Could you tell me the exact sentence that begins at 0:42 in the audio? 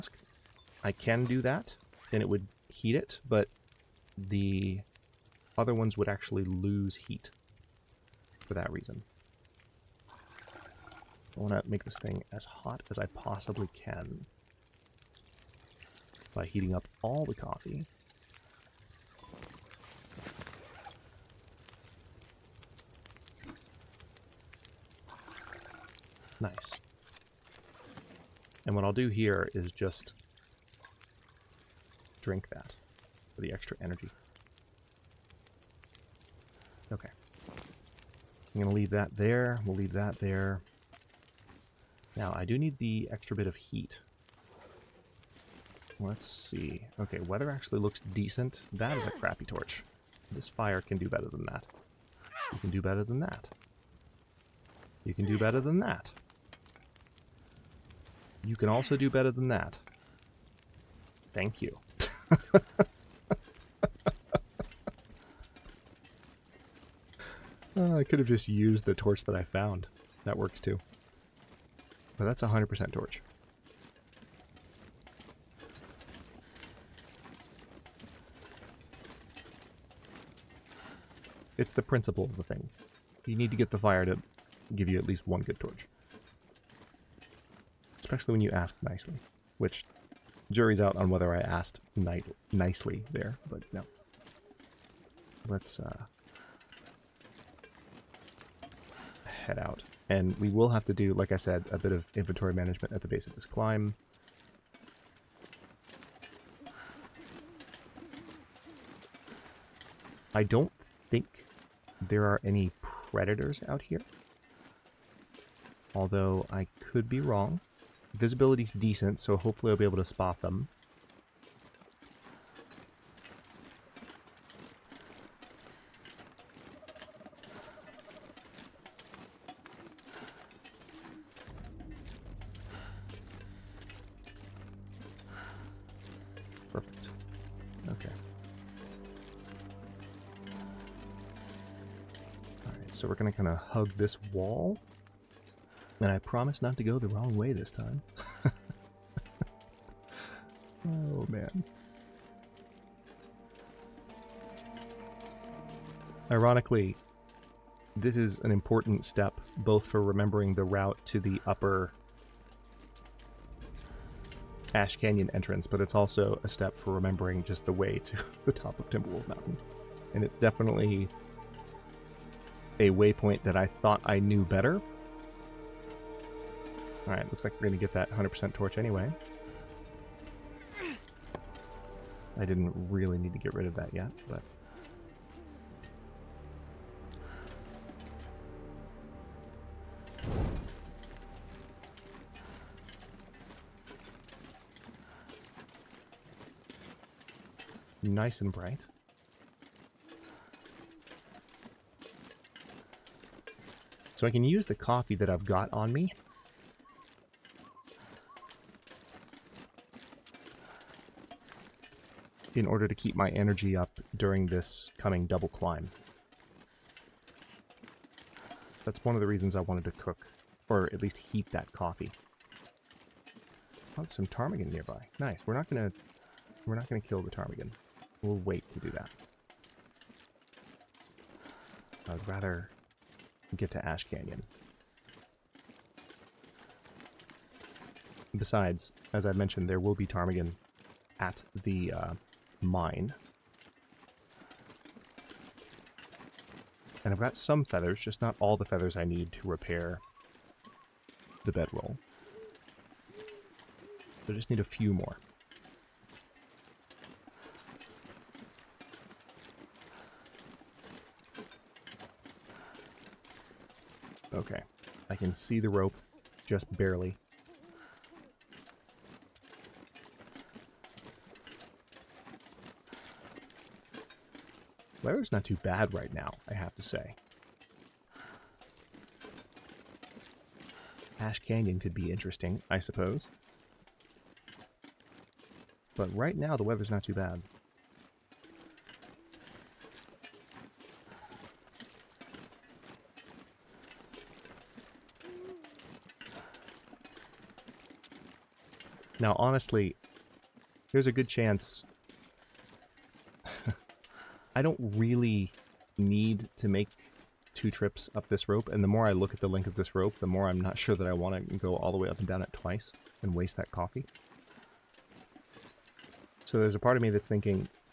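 Now, I do need the extra bit of heat Let's see.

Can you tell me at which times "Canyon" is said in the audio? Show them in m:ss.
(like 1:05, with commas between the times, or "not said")
2:44, 3:54, 4:41.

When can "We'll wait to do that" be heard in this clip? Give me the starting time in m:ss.
3:48.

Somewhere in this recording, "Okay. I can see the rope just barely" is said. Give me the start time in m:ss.
4:24.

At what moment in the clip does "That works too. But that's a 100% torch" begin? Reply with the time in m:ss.
1:10.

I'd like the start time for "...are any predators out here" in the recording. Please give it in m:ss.
1:52.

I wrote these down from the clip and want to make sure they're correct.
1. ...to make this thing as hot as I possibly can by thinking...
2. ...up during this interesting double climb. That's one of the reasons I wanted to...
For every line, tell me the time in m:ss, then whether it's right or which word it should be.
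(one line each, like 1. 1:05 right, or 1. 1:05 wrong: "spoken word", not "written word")
1. 0:11 wrong: "heating", not "thinking"
2. 3:33 wrong: "coming", not "interesting".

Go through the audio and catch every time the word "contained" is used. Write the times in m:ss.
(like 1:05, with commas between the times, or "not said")
not said.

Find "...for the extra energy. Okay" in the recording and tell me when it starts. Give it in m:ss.
0:33.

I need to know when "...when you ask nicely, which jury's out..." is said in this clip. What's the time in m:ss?
1:28.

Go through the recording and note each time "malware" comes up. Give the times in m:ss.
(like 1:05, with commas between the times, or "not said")
not said.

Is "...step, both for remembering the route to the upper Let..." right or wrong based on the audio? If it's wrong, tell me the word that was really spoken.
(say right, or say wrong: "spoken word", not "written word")
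wrong: "Ash", not "Let".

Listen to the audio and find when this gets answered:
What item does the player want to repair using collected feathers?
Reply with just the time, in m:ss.
4:11.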